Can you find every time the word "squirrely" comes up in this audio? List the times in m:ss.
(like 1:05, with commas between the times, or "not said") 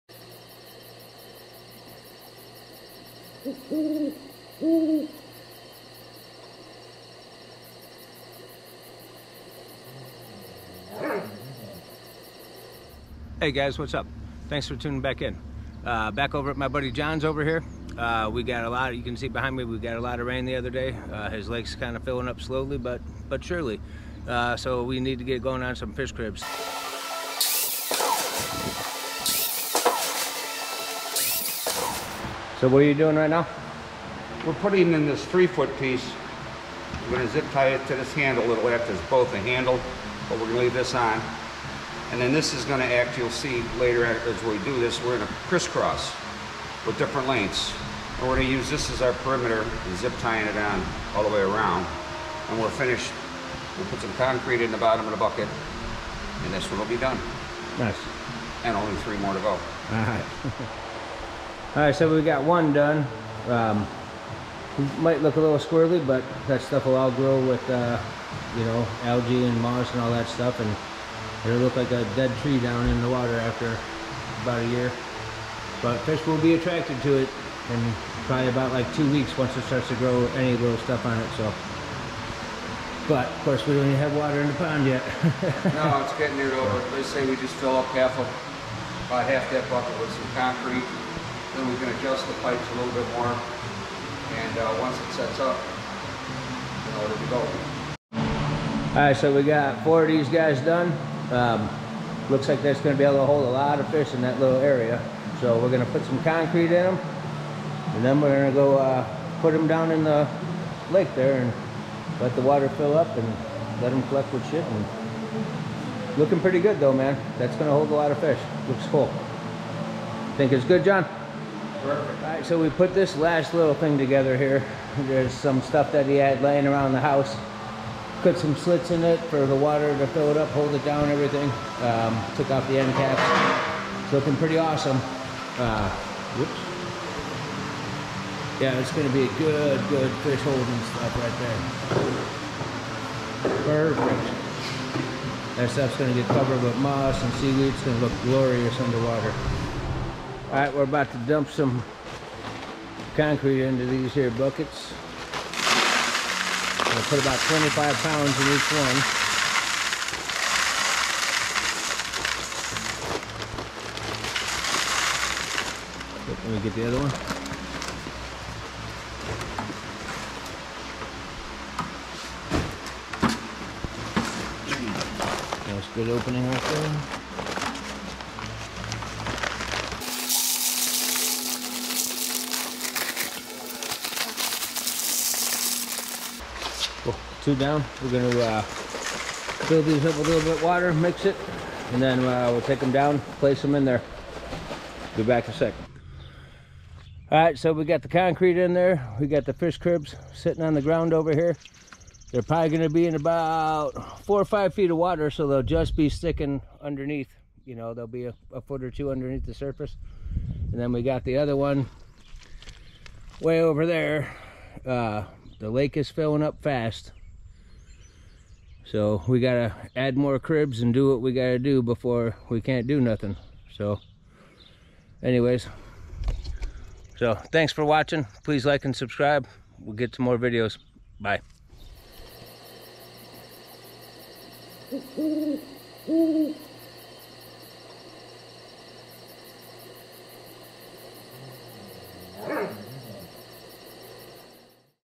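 1:05.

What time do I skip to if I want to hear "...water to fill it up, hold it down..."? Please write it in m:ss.
2:09.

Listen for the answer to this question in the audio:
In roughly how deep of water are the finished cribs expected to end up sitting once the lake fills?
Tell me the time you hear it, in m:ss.
3:24.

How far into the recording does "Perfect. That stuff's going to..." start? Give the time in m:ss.
2:23.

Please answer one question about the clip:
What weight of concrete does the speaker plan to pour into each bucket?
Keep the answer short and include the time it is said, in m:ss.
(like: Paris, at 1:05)
25 pounds, at 2:37.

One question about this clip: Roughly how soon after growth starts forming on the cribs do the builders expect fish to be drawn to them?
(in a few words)
About 2 weeks.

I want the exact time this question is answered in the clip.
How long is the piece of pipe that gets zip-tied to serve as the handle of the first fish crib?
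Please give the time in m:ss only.
0:35.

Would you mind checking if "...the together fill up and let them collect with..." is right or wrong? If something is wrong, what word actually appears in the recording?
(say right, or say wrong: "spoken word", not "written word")
wrong: "water", not "together".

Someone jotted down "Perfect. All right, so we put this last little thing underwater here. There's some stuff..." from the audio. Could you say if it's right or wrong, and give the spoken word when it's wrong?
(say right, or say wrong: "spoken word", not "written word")
wrong: "together", not "underwater".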